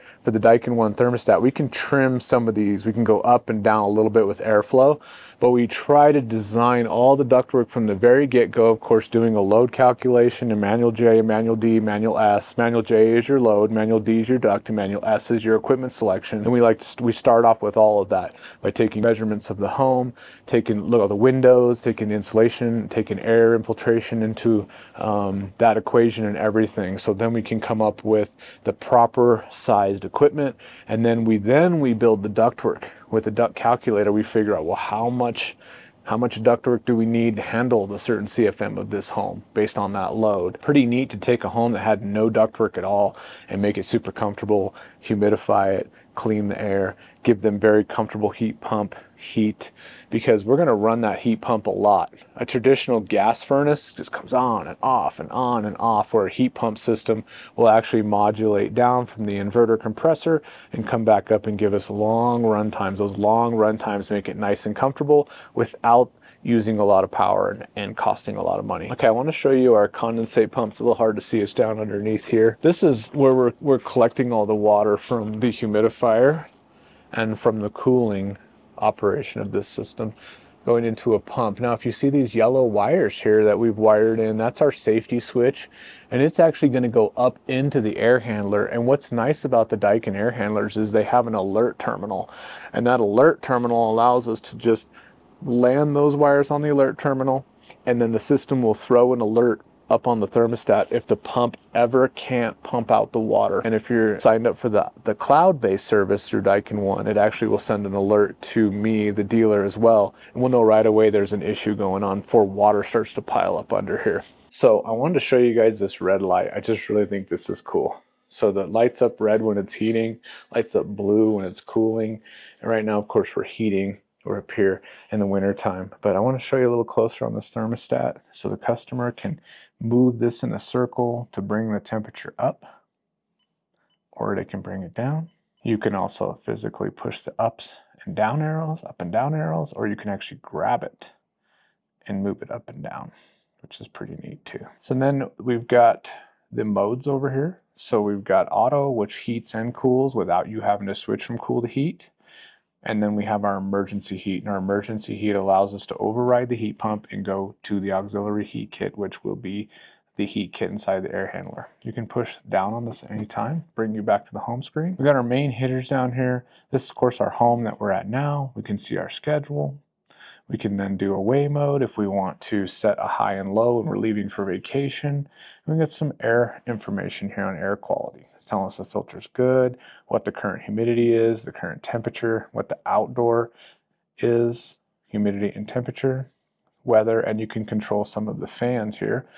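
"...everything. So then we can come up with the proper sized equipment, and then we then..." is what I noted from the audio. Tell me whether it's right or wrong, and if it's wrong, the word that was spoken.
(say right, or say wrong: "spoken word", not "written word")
right.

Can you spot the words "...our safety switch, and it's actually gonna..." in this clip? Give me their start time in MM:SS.
01:24.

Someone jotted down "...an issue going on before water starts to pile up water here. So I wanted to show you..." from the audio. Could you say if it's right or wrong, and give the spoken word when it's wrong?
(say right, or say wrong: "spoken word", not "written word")
wrong: "under", not "water".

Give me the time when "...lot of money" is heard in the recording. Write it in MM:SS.
01:08.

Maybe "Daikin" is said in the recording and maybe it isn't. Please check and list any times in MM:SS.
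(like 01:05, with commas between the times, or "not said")
00:00, 01:29, 01:46.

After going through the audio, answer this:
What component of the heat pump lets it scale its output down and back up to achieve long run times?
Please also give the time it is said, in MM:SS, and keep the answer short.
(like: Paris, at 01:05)
inverter compressor, at 00:59.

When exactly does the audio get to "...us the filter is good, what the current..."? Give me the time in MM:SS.
02:58.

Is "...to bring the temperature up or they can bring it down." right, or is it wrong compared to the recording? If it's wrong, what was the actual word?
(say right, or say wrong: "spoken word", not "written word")
right.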